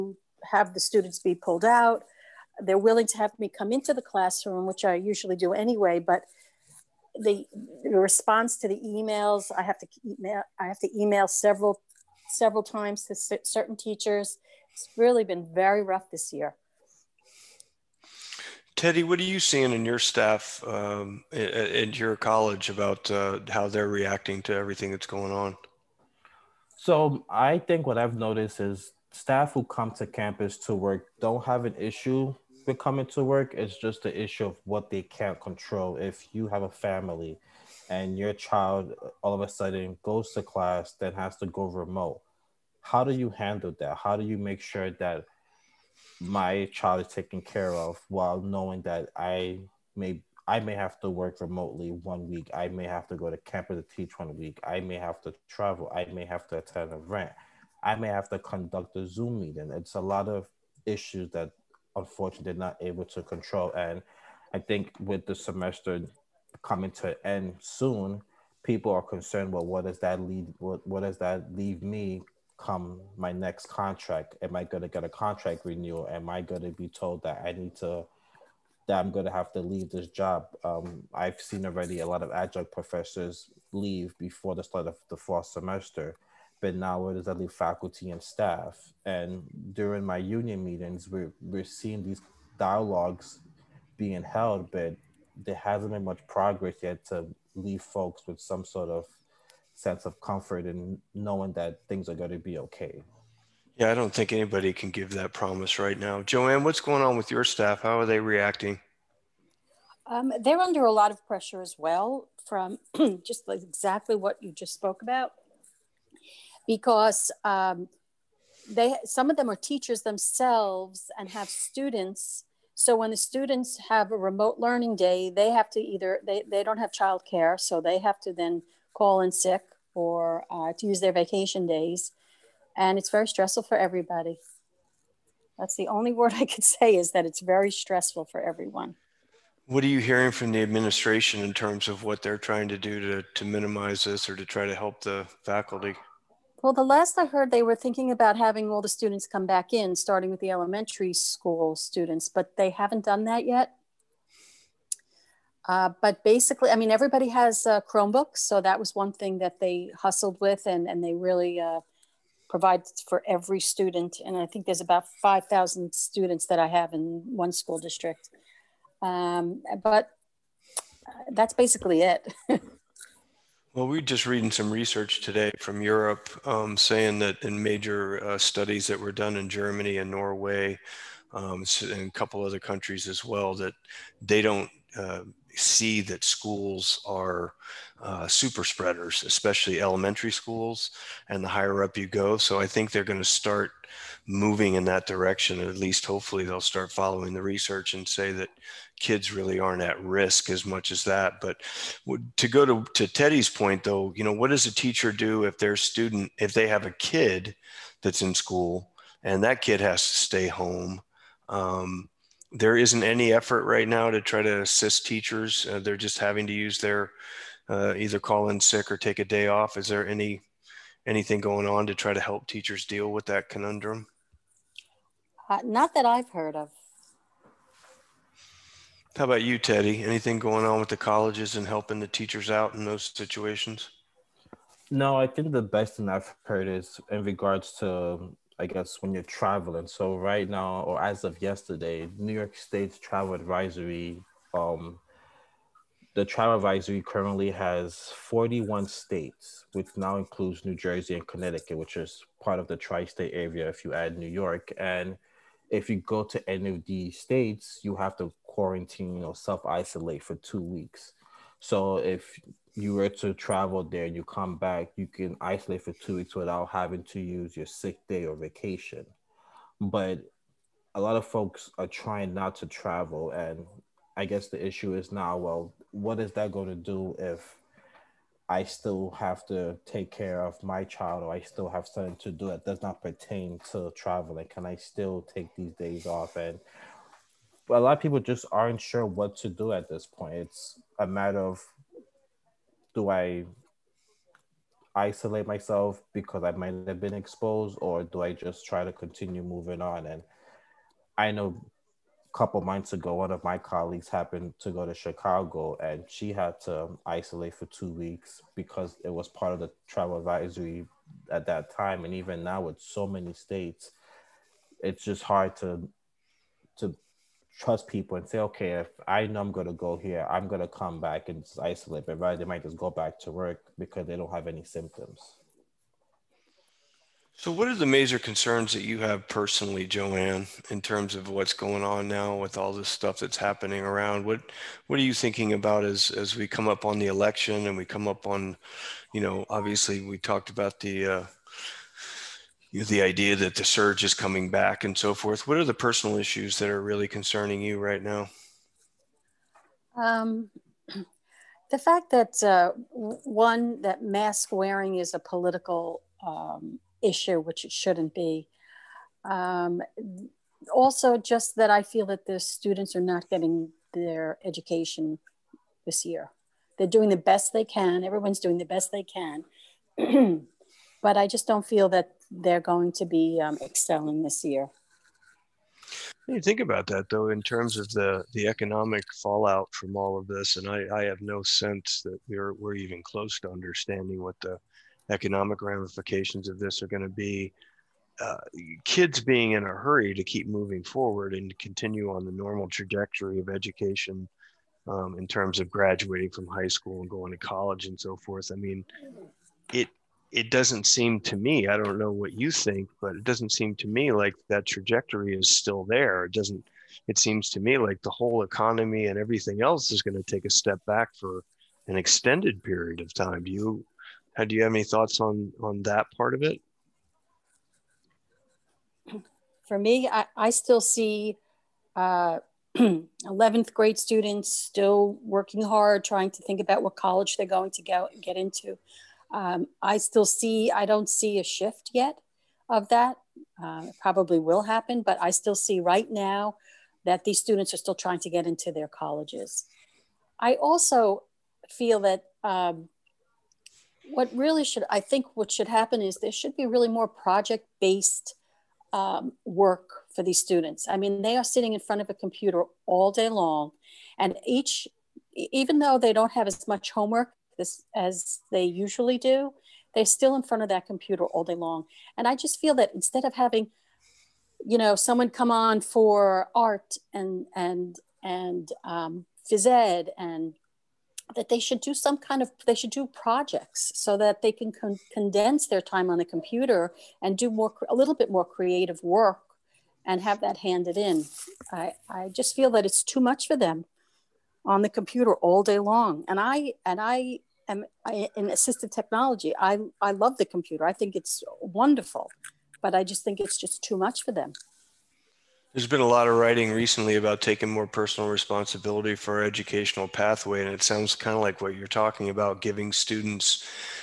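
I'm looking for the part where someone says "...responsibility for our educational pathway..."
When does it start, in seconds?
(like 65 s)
498 s.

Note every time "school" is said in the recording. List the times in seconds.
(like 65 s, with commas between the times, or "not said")
151 s, 167 s, 186 s, 190 s, 208 s, 396 s.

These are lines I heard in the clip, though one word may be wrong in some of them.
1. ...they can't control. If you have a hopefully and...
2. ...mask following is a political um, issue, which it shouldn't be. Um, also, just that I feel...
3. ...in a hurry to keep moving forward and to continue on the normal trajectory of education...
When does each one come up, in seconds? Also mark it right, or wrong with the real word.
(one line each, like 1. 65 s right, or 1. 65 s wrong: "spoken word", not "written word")
1. 34 s wrong: "family", not "hopefully"
2. 354 s wrong: "wearing", not "following"
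3. 389 s right.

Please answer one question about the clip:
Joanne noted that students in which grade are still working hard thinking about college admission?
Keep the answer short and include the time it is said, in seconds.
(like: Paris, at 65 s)
11th grade, at 422 s.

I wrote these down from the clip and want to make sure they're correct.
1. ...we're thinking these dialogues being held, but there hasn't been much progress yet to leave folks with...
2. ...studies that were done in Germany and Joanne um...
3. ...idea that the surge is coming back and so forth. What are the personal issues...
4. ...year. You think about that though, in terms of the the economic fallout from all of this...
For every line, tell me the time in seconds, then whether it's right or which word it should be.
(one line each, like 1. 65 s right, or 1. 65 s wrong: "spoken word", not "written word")
1. 91 s wrong: "seeing", not "thinking"
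2. 178 s wrong: "Norway", not "Joanne"
3. 343 s right
4. 374 s right.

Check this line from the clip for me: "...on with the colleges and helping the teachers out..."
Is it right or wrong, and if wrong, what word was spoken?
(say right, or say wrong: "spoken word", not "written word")
right.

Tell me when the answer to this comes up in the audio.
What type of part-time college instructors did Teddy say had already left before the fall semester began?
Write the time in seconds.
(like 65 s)
82 s.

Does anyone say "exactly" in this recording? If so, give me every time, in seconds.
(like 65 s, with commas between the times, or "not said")
113 s.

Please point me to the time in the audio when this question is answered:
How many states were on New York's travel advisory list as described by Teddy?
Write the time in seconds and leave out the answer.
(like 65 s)
248 s.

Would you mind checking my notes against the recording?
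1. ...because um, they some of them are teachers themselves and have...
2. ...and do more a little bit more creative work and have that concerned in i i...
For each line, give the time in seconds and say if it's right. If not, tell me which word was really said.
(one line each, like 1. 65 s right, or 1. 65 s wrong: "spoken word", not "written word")
1. 116 s right
2. 477 s wrong: "handed", not "concerned".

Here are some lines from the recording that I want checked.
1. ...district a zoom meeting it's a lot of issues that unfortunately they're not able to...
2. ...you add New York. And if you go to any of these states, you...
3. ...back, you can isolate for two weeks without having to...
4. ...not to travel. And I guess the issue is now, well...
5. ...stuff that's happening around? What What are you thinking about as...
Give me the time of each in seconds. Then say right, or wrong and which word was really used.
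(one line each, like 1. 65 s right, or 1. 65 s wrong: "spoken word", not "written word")
1. 58 s wrong: "conduct", not "district"
2. 253 s right
3. 264 s right
4. 272 s right
5. 332 s right.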